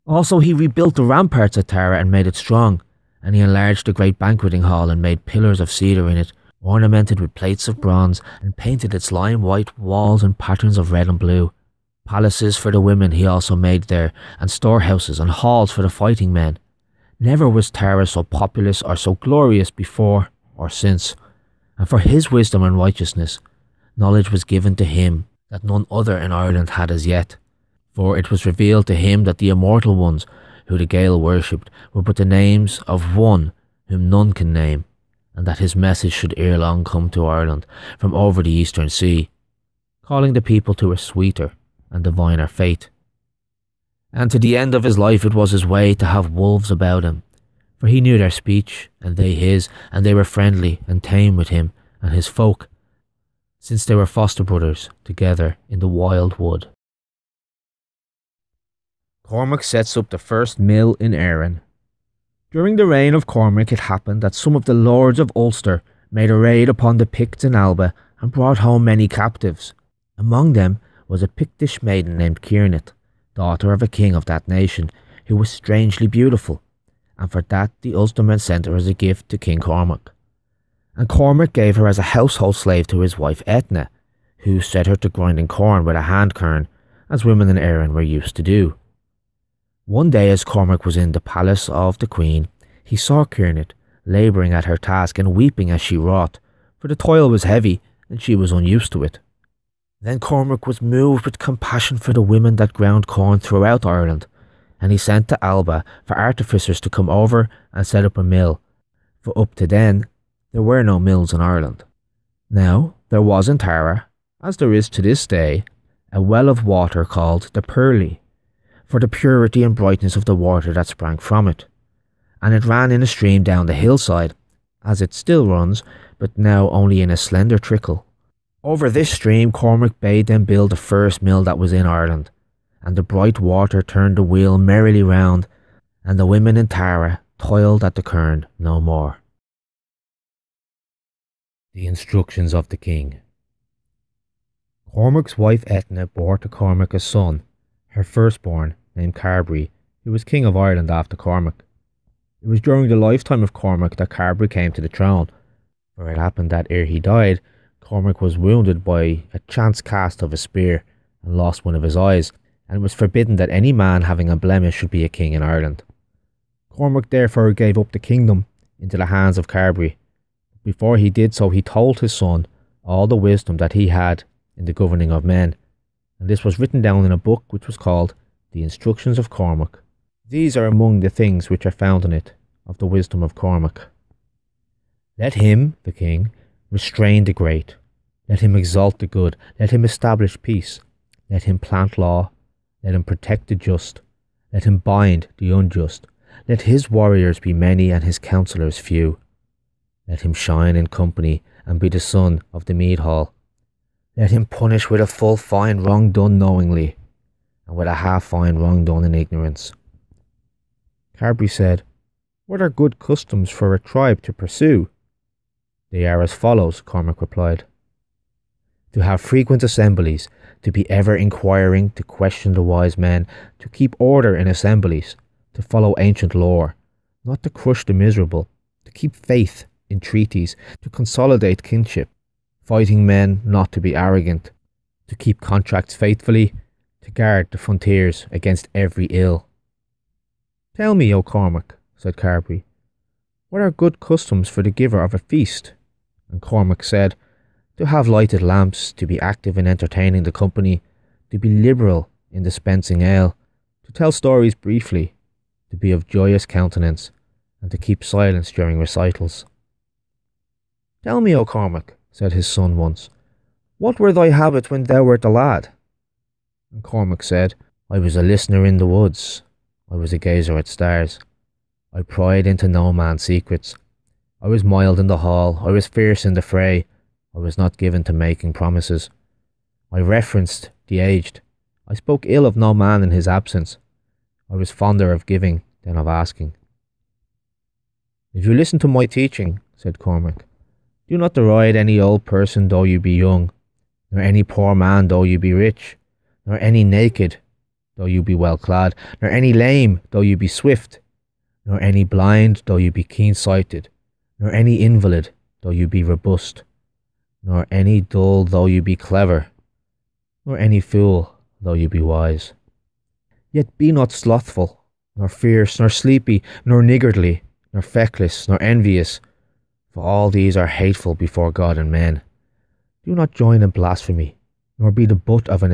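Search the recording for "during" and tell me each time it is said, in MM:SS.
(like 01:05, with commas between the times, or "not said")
01:02, 02:32, 04:18.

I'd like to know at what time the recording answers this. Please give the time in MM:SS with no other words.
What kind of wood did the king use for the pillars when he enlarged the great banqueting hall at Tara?
00:05.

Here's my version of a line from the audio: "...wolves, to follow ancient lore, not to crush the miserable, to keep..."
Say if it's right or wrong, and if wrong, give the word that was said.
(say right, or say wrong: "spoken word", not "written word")
wrong: "assemblies", not "wolves".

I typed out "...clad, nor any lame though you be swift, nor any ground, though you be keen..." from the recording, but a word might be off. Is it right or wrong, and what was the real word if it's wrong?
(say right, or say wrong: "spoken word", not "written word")
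wrong: "blind", not "ground".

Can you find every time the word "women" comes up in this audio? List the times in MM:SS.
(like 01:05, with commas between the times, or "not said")
00:12, 01:27, 01:42, 02:16.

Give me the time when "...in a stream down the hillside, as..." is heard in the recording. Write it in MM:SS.
02:02.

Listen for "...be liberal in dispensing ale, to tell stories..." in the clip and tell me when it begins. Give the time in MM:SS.
04:11.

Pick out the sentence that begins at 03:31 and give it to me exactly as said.
Carberry said, What are good customs for a tribe to pursue?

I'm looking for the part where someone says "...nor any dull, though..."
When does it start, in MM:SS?
05:07.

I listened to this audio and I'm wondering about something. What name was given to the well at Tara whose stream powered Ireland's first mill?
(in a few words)
The Pearly.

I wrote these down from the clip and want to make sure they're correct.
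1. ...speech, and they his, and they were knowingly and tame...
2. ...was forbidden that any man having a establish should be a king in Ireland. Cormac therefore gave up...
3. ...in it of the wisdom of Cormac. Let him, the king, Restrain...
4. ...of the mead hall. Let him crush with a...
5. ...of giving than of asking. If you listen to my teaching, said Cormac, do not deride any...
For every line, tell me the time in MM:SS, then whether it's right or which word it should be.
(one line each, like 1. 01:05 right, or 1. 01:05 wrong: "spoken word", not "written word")
1. 00:48 wrong: "friendly", not "knowingly"
2. 02:42 wrong: "blemish", not "establish"
3. 03:02 right
4. 03:22 wrong: "punish", not "crush"
5. 04:45 right.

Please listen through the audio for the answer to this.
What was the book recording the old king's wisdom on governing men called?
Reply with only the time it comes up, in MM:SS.
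02:58.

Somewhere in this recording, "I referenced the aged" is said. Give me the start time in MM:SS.
04:39.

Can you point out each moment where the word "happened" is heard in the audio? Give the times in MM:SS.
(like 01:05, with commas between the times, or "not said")
01:03, 02:36.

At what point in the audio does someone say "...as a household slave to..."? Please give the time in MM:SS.
01:21.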